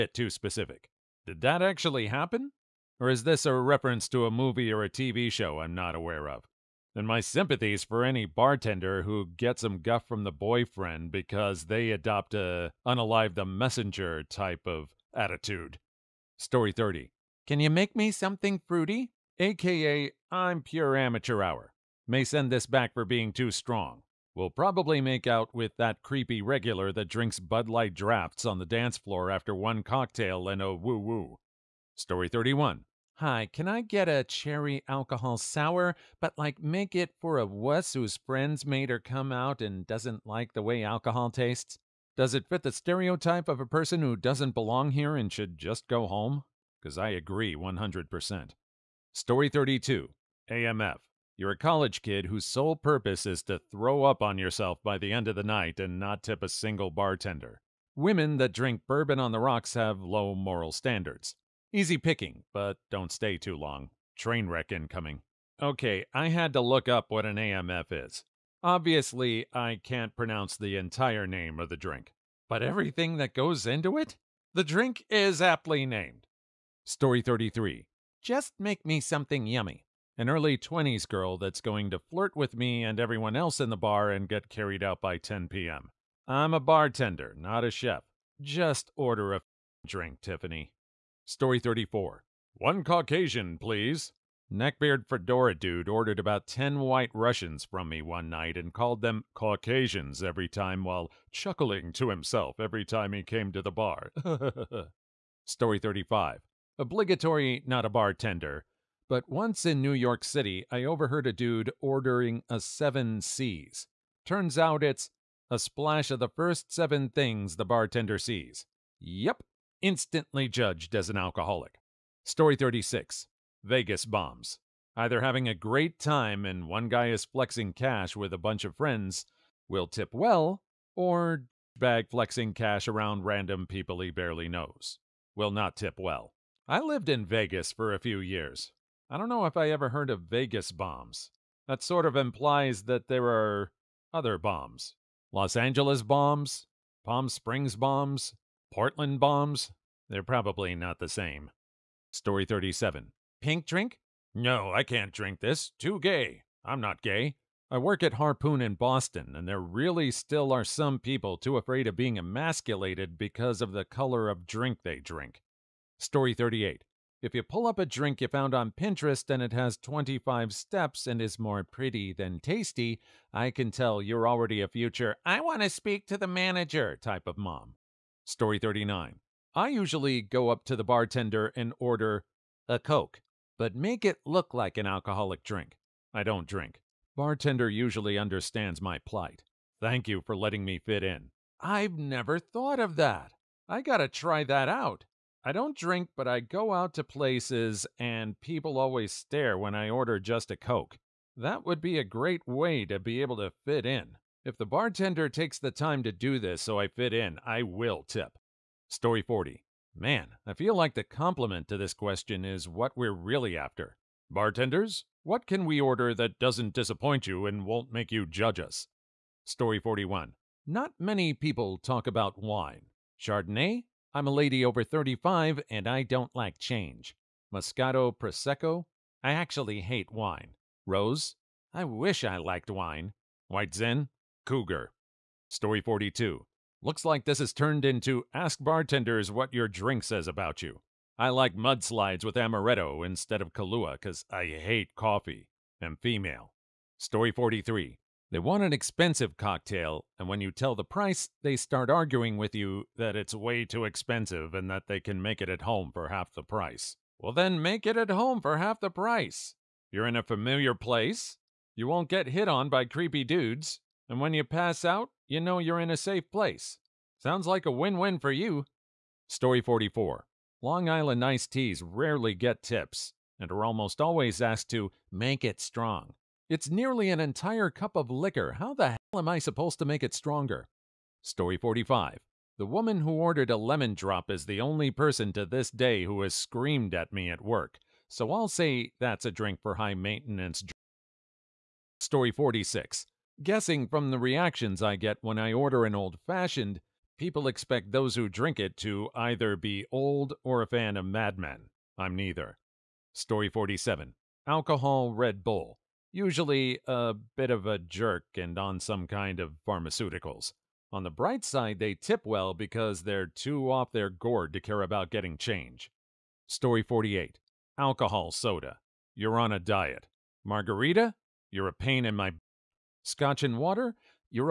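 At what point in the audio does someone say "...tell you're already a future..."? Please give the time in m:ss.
2:53.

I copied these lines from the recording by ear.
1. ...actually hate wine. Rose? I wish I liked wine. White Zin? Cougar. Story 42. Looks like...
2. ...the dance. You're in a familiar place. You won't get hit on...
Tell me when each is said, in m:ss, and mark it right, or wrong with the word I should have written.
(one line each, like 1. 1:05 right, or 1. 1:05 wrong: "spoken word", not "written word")
1. 3:49 right
2. 4:18 wrong: "price", not "dance".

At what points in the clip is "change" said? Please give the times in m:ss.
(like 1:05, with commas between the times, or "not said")
3:46, 5:15.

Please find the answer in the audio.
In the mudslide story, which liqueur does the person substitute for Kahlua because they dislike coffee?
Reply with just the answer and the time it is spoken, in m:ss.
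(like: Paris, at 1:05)
amaretto, at 4:02.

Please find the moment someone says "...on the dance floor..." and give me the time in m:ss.
0:28.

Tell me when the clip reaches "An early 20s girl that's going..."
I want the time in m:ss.
1:20.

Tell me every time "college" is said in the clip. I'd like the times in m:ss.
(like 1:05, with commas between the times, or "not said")
0:51.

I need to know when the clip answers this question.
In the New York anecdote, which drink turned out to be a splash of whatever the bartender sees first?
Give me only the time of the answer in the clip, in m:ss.
1:52.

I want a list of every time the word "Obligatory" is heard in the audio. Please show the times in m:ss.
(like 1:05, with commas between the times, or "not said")
1:46.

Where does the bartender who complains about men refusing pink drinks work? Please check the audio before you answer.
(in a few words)
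Harpoon.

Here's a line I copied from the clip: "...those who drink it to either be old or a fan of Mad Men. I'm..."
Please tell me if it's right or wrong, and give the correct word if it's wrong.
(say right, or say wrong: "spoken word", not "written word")
right.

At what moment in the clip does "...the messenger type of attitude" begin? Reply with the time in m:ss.
0:13.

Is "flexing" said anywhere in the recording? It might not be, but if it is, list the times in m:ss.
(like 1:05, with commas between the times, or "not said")
2:07, 2:12.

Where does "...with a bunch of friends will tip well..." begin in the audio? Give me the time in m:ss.
2:08.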